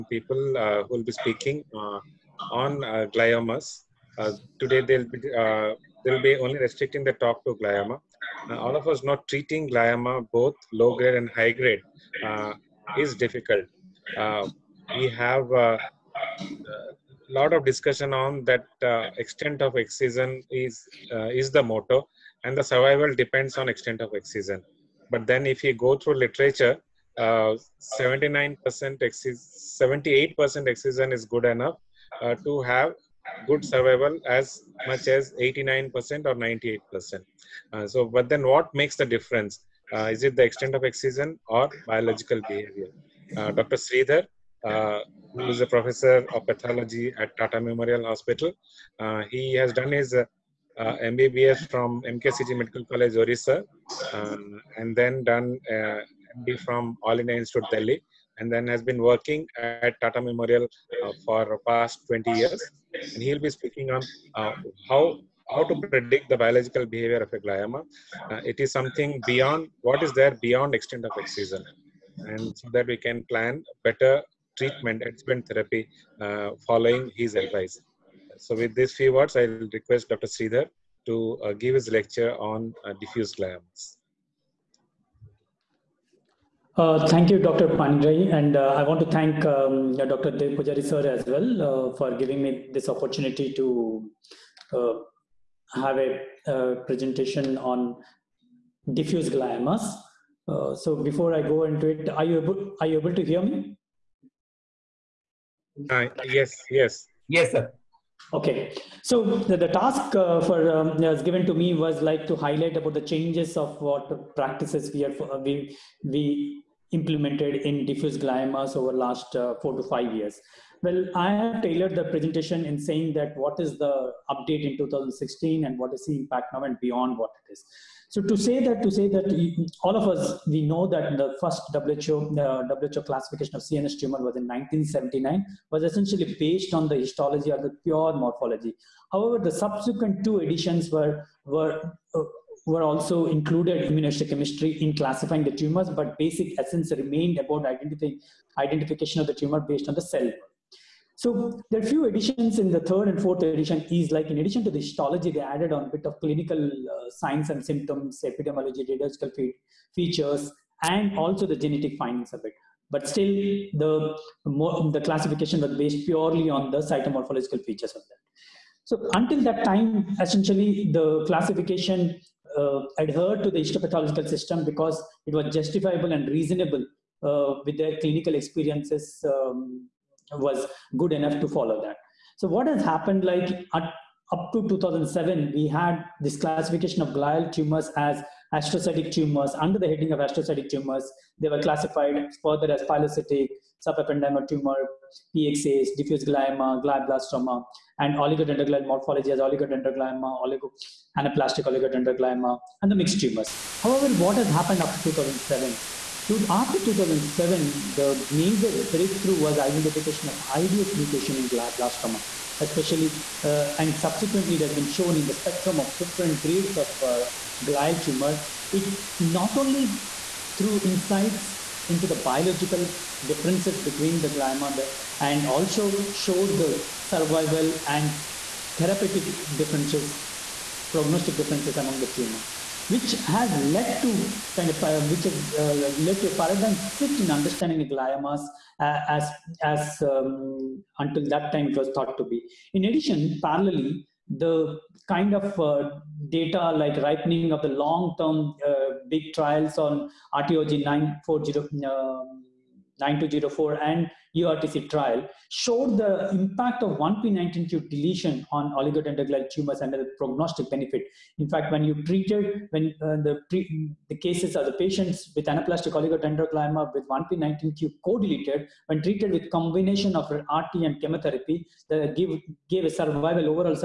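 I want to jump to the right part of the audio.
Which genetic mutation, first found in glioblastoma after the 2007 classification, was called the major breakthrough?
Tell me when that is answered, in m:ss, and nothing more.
3:30.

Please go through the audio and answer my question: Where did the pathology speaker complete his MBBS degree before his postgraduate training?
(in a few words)
MKCG Medical College, Orissa.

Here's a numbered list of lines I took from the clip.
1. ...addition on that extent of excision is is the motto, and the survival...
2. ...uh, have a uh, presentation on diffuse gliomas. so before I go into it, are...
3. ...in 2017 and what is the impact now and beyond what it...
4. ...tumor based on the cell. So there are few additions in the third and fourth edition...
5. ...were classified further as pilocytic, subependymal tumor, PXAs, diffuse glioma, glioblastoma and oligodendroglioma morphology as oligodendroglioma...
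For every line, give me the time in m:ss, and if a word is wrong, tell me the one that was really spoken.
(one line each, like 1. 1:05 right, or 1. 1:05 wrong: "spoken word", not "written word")
1. 0:17 wrong: "discussion", not "addition"
2. 1:34 right
3. 2:04 wrong: "2016", not "2017"
4. 2:29 right
5. 3:11 right.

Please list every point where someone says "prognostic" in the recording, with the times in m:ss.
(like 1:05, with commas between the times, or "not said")
3:50, 4:20.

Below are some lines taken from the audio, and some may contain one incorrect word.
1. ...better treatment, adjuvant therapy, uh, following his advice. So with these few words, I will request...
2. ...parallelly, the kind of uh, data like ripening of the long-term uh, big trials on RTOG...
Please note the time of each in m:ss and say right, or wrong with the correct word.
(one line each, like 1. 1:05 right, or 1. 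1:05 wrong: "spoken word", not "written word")
1. 1:13 right
2. 4:03 right.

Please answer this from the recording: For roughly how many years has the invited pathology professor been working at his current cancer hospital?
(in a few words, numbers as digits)
20 years.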